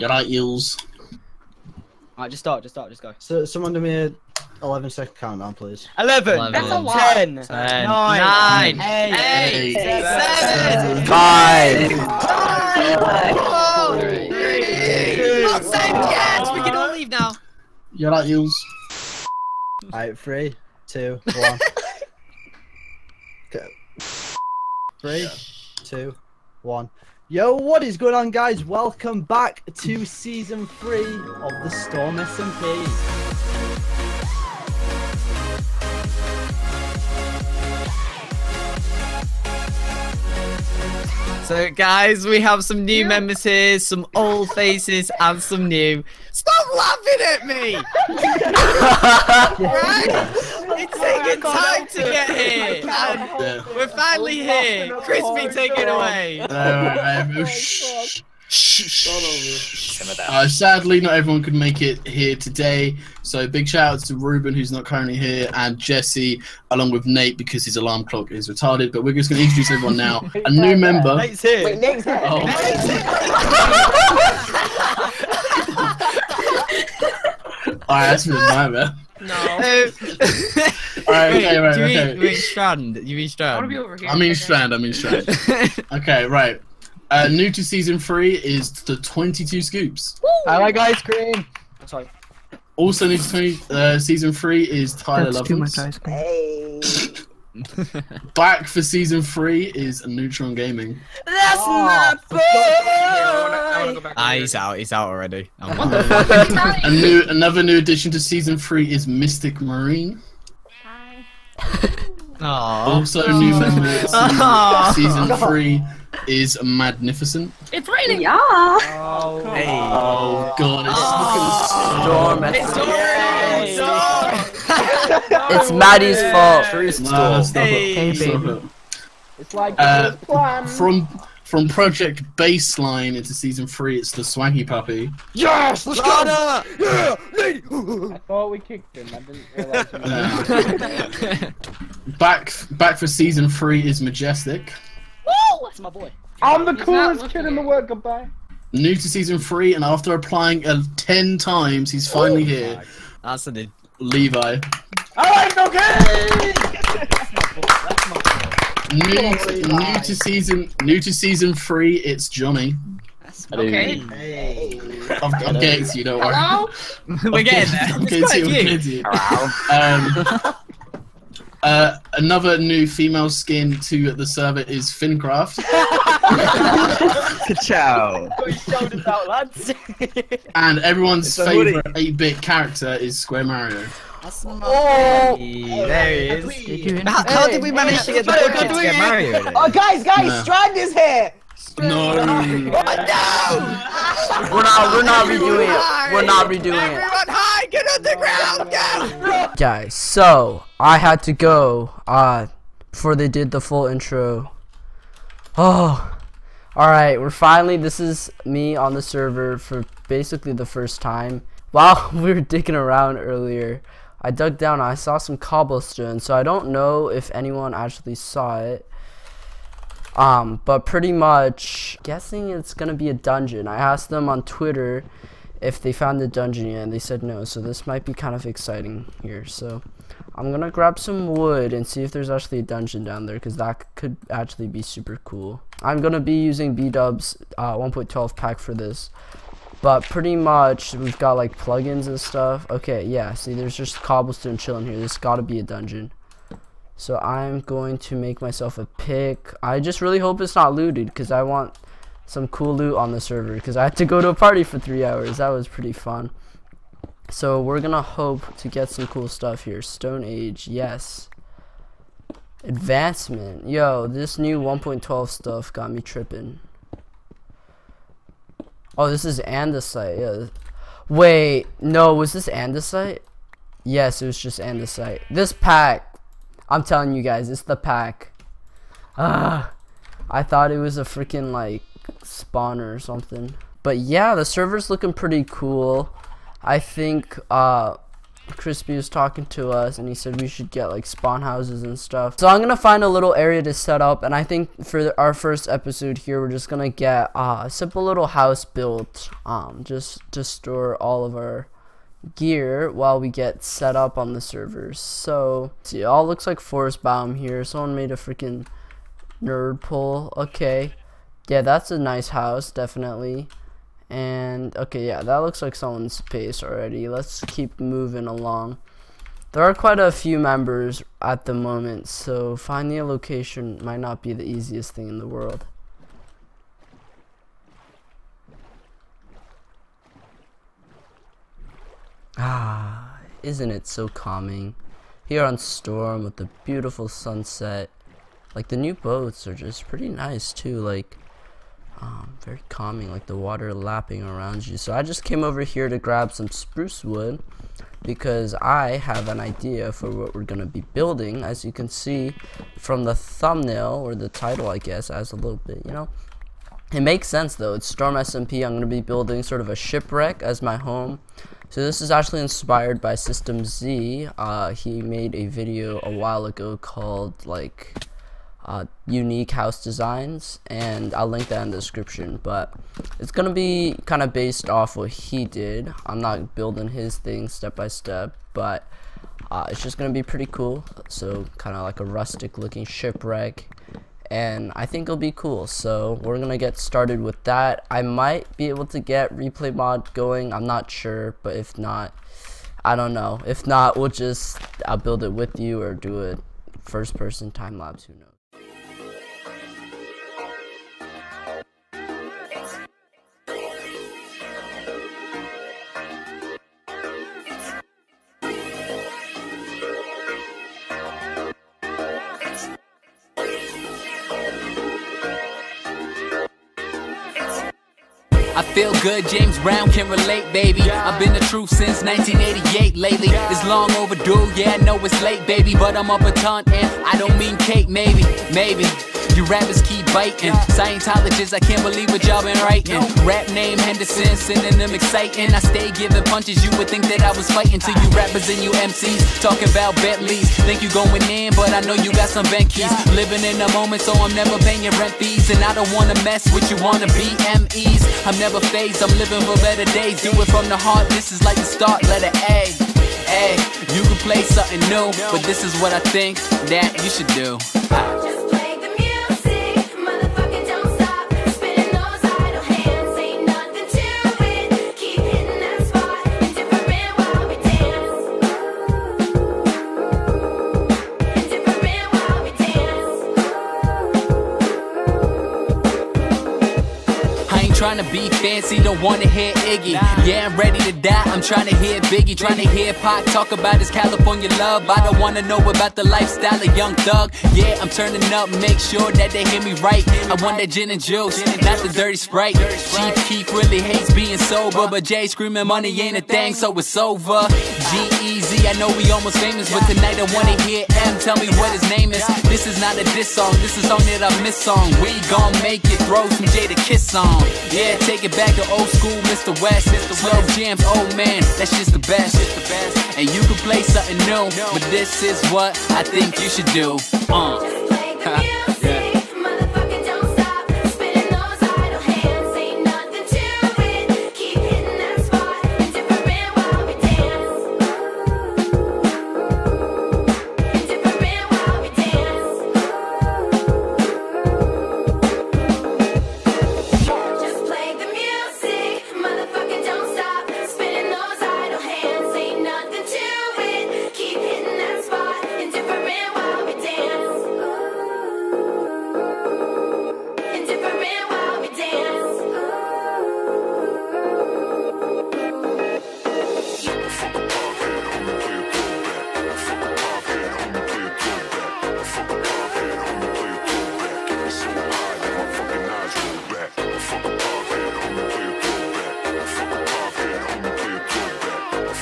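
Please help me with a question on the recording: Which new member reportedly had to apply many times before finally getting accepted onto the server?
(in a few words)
Levi.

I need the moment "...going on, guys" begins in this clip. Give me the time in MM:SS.
00:27.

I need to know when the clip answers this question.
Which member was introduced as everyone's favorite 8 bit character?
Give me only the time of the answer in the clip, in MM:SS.
03:03.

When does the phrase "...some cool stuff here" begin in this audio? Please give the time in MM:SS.
04:18.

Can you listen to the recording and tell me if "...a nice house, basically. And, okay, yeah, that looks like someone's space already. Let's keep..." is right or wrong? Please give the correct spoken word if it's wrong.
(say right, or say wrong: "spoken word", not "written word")
wrong: "definitely", not "basically".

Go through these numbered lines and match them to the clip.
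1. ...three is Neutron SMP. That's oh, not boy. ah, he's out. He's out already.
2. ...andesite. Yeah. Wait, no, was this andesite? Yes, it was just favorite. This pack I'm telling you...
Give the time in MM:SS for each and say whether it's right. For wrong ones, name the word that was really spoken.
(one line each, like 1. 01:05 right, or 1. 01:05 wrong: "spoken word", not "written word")
1. 01:39 wrong: "Gaming", not "SMP"
2. 04:29 wrong: "andesite", not "favorite".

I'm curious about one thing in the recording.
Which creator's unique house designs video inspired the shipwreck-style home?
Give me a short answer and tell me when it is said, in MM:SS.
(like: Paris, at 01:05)
SystemZee, at 06:03.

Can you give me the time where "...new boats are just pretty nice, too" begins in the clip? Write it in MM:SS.
05:38.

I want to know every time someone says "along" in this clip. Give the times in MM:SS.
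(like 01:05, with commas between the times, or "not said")
01:06, 05:18.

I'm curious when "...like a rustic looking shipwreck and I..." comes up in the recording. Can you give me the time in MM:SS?
06:21.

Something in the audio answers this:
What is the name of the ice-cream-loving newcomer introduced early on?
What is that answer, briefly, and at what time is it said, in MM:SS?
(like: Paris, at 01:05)
22 Scoops, at 01:28.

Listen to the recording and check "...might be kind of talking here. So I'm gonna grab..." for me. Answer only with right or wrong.
wrong.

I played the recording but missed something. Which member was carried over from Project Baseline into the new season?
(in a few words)
Swanky Puppy.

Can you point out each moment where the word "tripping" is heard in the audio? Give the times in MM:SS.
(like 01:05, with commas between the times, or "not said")
04:26.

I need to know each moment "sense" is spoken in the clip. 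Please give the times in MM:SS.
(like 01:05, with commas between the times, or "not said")
05:57.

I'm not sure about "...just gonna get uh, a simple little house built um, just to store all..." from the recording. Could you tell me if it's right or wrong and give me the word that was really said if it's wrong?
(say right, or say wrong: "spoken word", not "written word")
right.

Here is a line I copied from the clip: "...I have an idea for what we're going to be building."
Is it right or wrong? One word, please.
right.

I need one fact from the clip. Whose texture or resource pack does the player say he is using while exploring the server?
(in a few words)
B-Dub's.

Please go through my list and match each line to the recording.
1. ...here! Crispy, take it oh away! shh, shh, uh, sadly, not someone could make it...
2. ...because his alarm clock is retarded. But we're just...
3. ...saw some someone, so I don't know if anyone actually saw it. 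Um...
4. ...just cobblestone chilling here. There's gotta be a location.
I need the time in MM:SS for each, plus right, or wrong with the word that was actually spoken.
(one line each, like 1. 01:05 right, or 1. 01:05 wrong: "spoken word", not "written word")
1. 00:54 wrong: "everyone", not "someone"
2. 01:07 right
3. 03:34 wrong: "cobblestone", not "someone"
4. 04:03 wrong: "dungeon", not "location".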